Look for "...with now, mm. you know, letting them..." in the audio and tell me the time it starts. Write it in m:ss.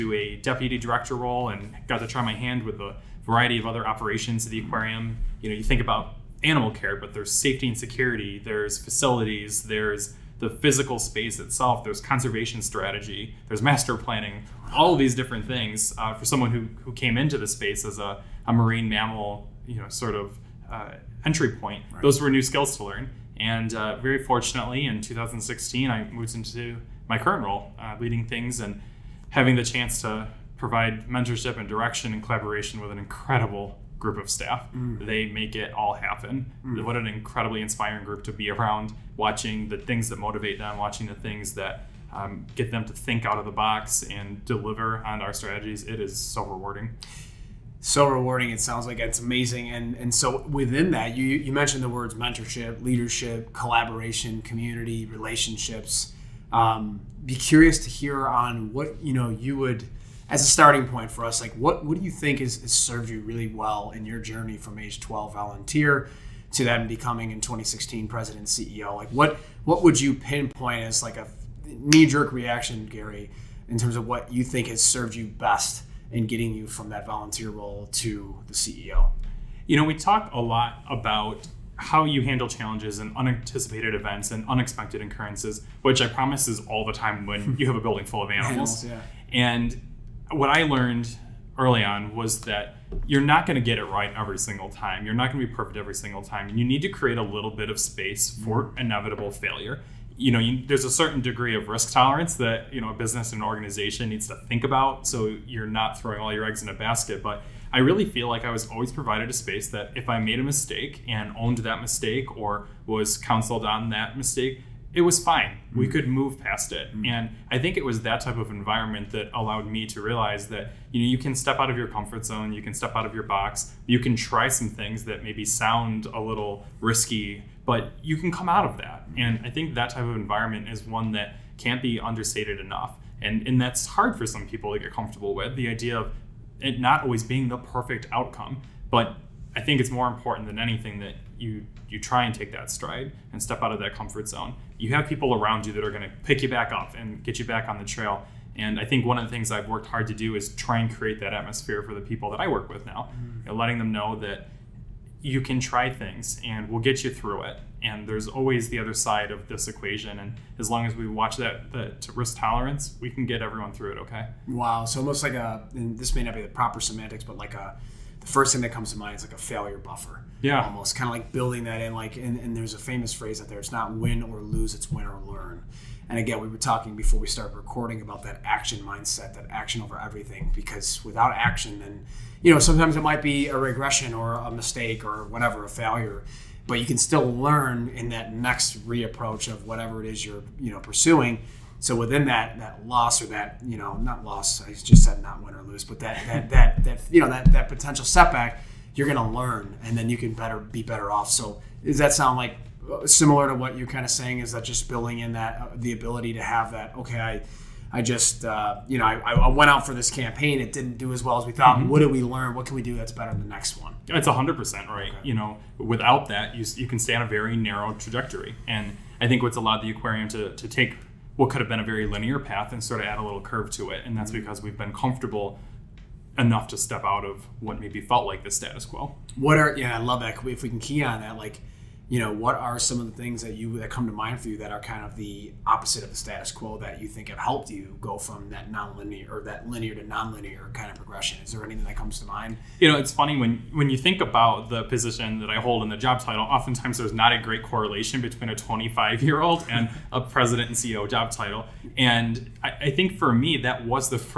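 2:32.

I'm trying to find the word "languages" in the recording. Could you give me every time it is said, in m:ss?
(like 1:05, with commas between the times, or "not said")
not said.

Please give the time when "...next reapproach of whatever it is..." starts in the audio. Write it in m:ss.
3:08.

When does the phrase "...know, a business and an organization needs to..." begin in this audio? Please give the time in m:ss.
1:42.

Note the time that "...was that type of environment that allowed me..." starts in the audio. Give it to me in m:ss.
1:57.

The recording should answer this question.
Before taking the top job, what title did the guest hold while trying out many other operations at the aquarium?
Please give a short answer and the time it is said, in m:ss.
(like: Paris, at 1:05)
Deputy director, at 0:00.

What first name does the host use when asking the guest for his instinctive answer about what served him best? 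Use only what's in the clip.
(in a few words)
Gary.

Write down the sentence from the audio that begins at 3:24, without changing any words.
Is that just building in that uh, the ability to have that?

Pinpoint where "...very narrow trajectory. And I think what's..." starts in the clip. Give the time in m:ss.
3:37.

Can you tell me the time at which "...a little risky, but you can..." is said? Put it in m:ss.
2:06.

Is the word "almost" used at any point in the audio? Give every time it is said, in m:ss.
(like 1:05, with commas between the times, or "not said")
2:45, 2:50.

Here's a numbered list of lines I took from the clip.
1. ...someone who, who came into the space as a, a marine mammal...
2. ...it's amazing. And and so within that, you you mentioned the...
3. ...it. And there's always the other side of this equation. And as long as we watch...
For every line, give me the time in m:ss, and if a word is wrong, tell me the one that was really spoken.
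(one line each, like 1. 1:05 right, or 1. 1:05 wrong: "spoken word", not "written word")
1. 0:16 right
2. 0:48 right
3. 2:37 right.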